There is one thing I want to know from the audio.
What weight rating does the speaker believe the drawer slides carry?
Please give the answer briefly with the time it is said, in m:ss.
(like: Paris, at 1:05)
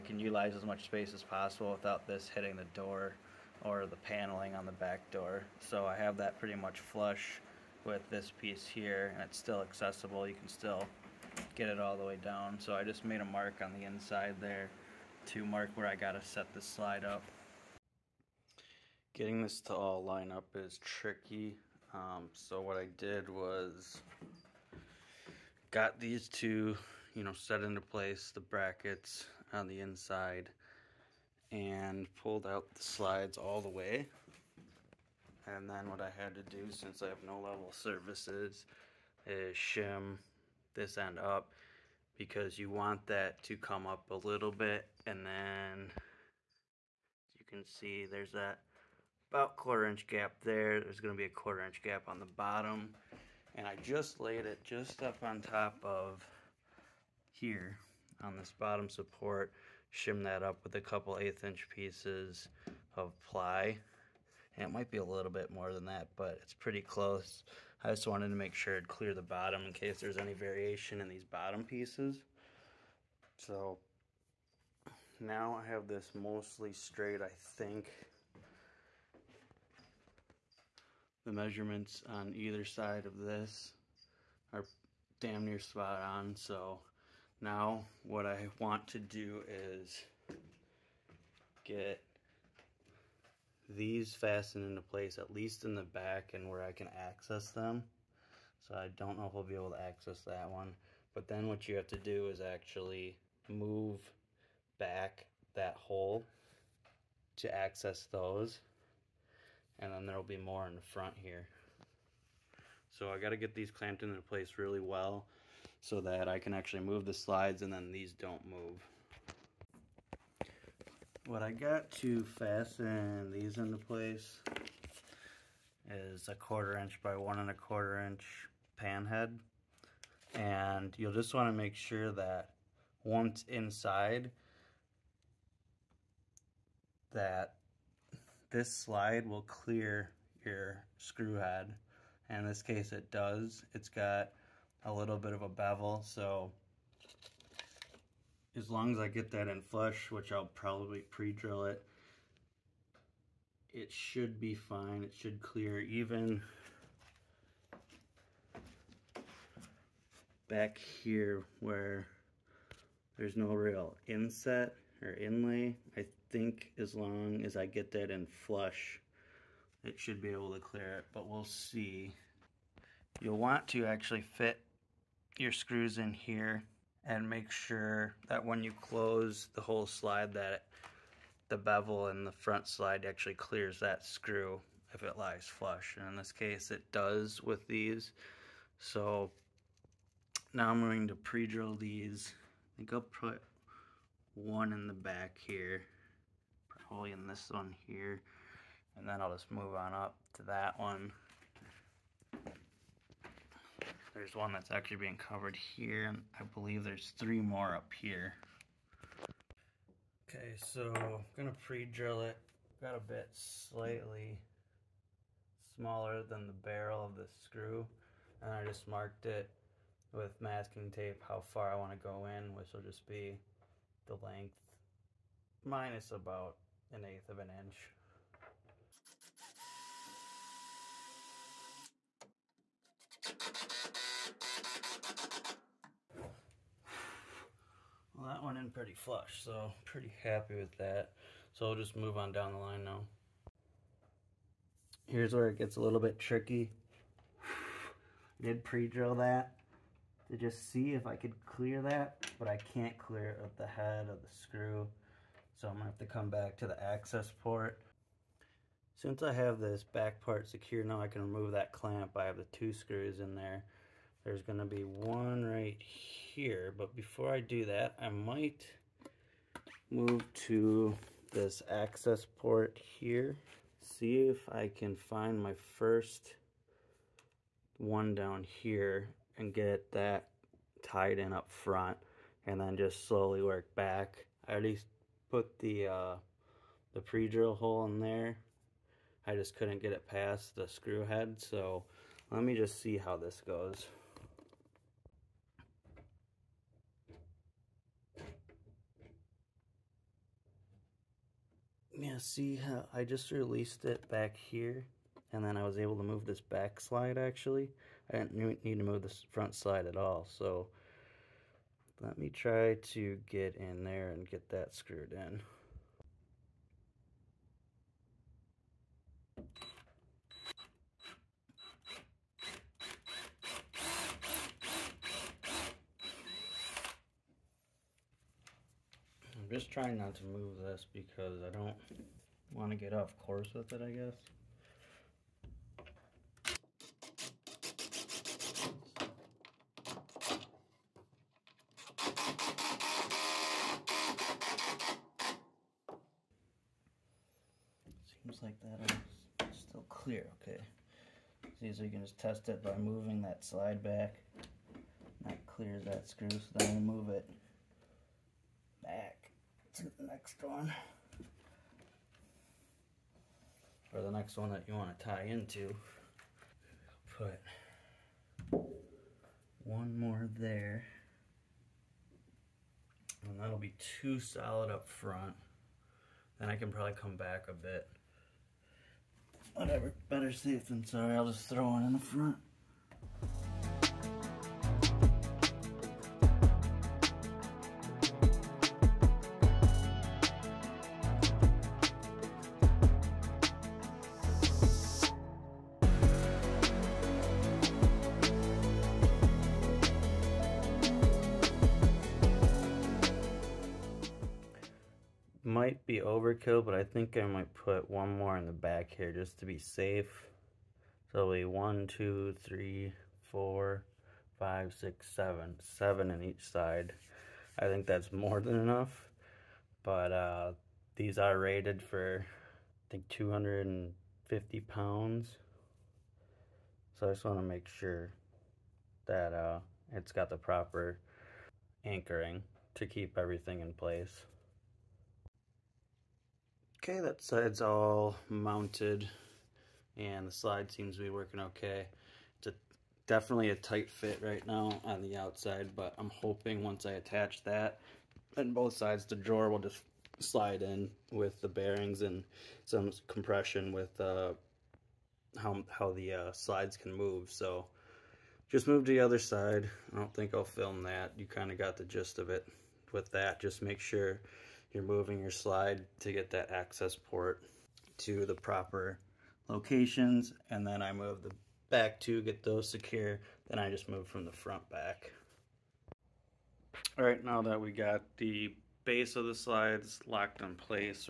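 250 pounds, at 7:03.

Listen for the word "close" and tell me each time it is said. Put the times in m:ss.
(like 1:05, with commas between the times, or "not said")
1:06, 2:58.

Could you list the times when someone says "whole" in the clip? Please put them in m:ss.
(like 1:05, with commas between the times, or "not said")
2:59.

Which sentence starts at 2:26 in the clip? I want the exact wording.
So as long as I get that in flush, which I'll probably pre-drill it, it should be fine.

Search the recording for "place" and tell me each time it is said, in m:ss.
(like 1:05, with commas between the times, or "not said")
0:27, 1:34, 1:54, 2:03, 7:13, 8:00.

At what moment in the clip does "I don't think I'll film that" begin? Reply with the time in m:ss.
7:39.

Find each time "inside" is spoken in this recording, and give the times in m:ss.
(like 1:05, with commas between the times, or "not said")
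0:13, 0:29, 2:13.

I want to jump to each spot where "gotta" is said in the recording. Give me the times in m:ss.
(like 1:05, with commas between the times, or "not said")
0:15.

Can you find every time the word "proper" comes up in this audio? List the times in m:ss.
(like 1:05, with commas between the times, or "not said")
7:10, 7:48.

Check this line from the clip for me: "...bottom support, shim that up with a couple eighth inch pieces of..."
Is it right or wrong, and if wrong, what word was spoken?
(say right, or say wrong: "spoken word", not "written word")
right.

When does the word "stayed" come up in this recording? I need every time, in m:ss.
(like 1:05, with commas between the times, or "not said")
not said.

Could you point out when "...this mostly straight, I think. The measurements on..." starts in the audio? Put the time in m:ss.
1:15.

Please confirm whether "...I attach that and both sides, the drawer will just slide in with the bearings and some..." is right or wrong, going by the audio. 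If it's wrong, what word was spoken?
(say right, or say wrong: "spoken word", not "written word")
right.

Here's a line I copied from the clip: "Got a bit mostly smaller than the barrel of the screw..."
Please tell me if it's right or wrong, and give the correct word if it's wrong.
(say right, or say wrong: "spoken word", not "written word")
wrong: "slightly", not "mostly".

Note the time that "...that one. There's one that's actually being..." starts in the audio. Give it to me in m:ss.
3:20.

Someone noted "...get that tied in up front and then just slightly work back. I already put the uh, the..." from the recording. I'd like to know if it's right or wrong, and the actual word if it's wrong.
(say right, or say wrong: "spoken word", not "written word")
wrong: "slowly", not "slightly".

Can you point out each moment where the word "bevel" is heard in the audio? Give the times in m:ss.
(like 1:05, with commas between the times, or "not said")
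2:25, 3:01.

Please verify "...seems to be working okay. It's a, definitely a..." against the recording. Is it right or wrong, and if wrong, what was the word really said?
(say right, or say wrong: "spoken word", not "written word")
right.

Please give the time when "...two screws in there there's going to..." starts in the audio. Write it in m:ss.
4:22.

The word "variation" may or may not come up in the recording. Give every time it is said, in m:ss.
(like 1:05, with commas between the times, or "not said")
1:10.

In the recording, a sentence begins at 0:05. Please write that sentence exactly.
So I have that pretty much flush with this piece here and it's still accessible.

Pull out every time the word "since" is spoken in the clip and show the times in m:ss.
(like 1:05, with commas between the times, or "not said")
0:36, 4:18.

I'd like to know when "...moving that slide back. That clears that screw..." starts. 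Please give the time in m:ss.
5:52.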